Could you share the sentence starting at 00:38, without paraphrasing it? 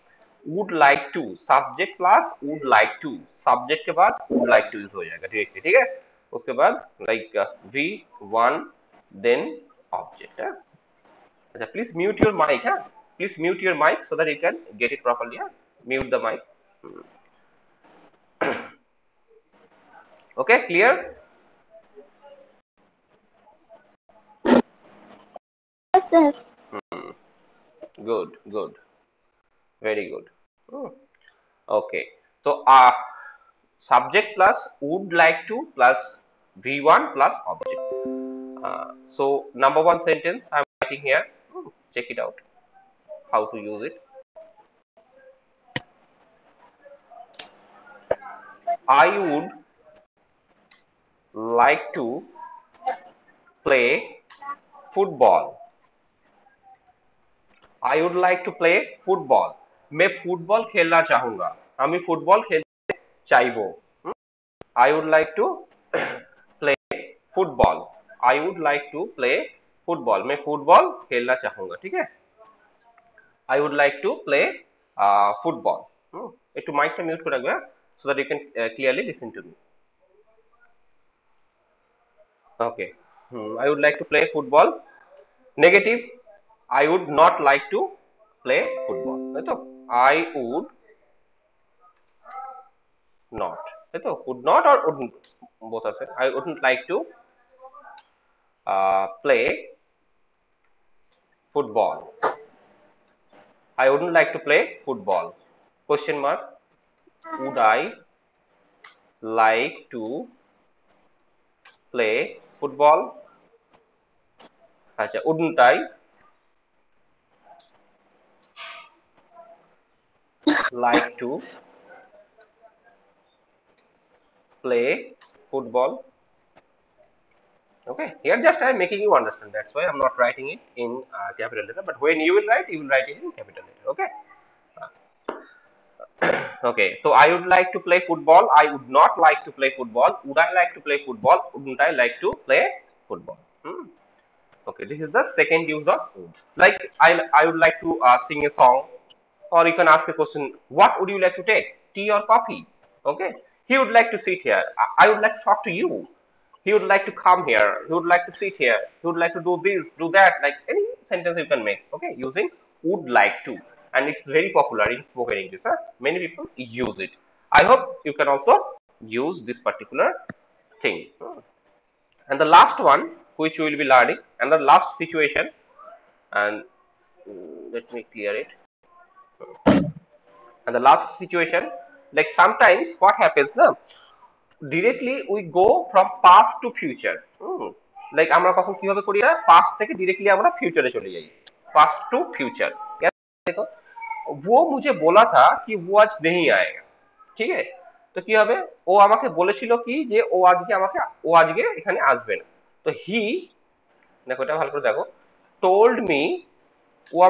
Uh, so, number one sentence I'm writing here.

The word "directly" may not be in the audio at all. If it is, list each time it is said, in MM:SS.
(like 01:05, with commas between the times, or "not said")
00:05, 03:04.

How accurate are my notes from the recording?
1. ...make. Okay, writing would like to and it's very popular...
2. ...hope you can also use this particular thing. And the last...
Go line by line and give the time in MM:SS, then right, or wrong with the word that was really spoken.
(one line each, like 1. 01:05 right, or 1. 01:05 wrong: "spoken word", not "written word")
1. 02:41 wrong: "using", not "writing"
2. 02:47 right.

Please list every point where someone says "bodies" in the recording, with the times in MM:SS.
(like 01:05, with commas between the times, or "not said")
not said.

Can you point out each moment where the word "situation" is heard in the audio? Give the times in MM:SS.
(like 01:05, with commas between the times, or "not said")
02:54, 03:01.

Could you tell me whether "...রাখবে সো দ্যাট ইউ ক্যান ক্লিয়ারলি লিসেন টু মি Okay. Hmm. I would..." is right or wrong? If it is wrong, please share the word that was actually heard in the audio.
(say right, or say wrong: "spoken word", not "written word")
right.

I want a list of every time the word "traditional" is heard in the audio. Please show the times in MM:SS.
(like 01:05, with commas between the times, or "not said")
not said.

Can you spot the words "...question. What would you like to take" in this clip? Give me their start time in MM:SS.
02:30.